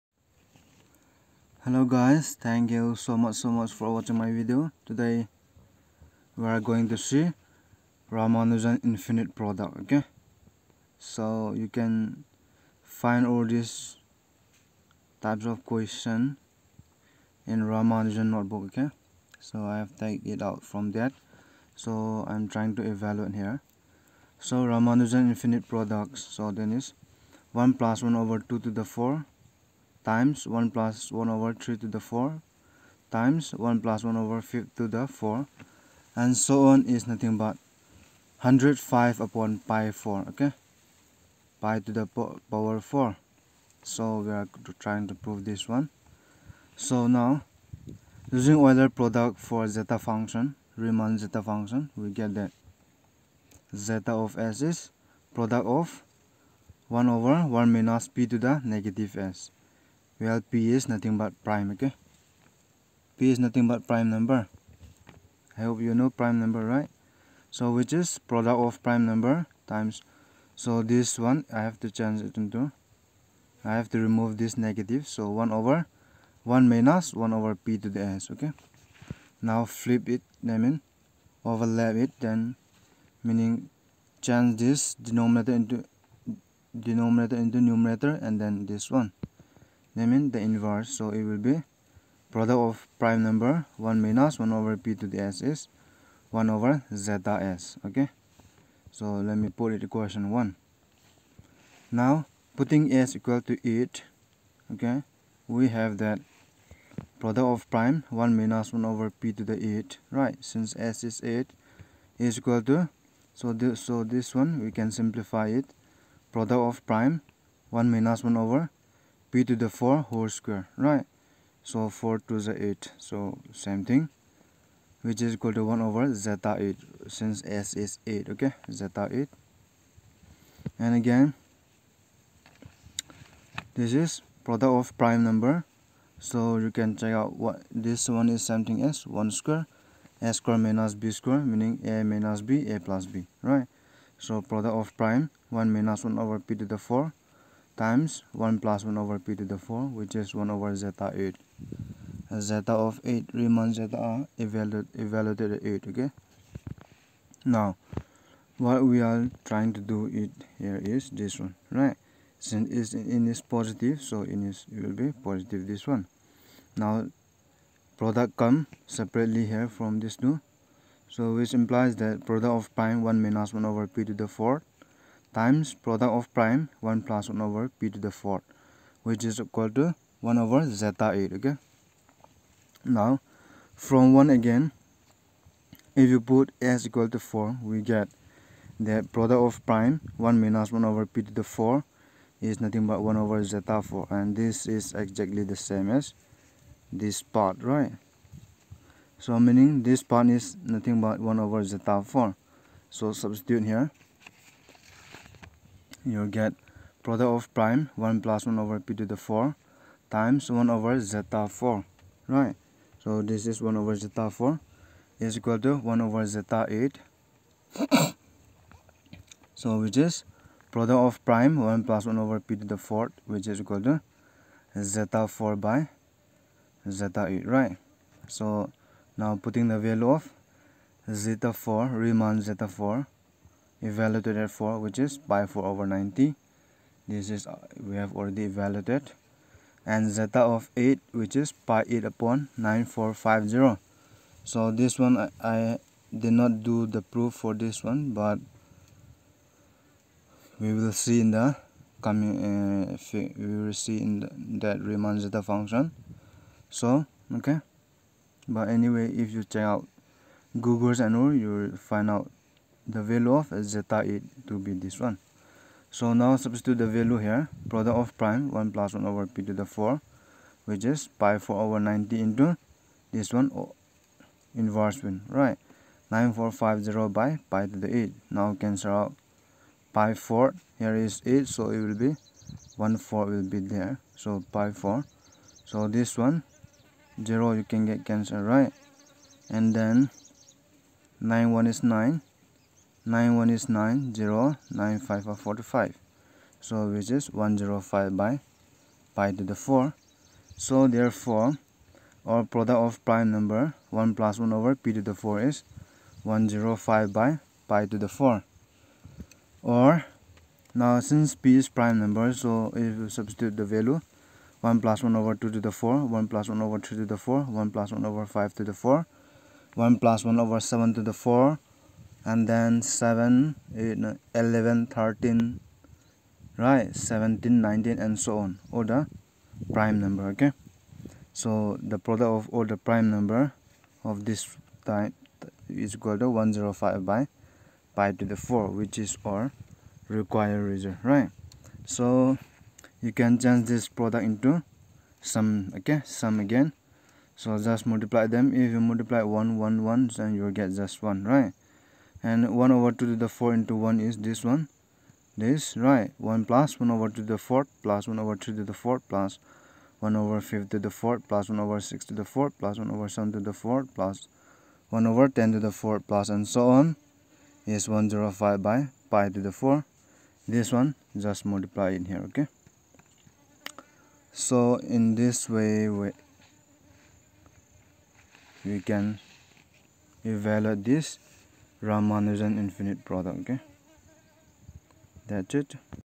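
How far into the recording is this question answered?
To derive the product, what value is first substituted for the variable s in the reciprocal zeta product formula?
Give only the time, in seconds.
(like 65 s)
102 s.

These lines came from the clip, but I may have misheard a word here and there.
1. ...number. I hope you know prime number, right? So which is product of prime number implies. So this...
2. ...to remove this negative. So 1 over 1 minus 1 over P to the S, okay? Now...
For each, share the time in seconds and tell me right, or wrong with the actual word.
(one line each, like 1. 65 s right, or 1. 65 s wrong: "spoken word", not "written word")
1. 64 s wrong: "times", not "implies"
2. 73 s right.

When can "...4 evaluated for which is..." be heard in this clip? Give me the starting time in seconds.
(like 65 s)
232 s.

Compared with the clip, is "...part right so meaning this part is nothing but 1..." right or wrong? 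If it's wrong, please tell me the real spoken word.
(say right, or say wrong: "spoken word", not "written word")
right.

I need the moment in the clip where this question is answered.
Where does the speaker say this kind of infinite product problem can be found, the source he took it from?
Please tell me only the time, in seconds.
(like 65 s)
17 s.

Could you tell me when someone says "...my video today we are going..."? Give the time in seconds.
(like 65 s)
4 s.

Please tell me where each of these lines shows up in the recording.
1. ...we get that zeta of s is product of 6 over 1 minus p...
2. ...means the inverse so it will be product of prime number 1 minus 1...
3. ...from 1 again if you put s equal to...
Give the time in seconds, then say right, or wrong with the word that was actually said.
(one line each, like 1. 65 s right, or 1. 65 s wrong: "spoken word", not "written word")
1. 51 s wrong: "1", not "6"
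2. 90 s right
3. 183 s right.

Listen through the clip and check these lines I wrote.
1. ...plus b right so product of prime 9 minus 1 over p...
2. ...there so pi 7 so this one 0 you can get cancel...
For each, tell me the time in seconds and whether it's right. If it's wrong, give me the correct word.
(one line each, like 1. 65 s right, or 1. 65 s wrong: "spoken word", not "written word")
1. 142 s wrong: "1", not "9"
2. 283 s wrong: "4", not "7".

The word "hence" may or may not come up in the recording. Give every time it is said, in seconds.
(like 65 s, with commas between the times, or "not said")
not said.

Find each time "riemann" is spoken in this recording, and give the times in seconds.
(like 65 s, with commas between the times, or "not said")
50 s, 153 s, 231 s, 254 s.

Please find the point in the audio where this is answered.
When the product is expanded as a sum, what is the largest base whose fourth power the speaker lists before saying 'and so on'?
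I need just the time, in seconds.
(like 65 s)
365 s.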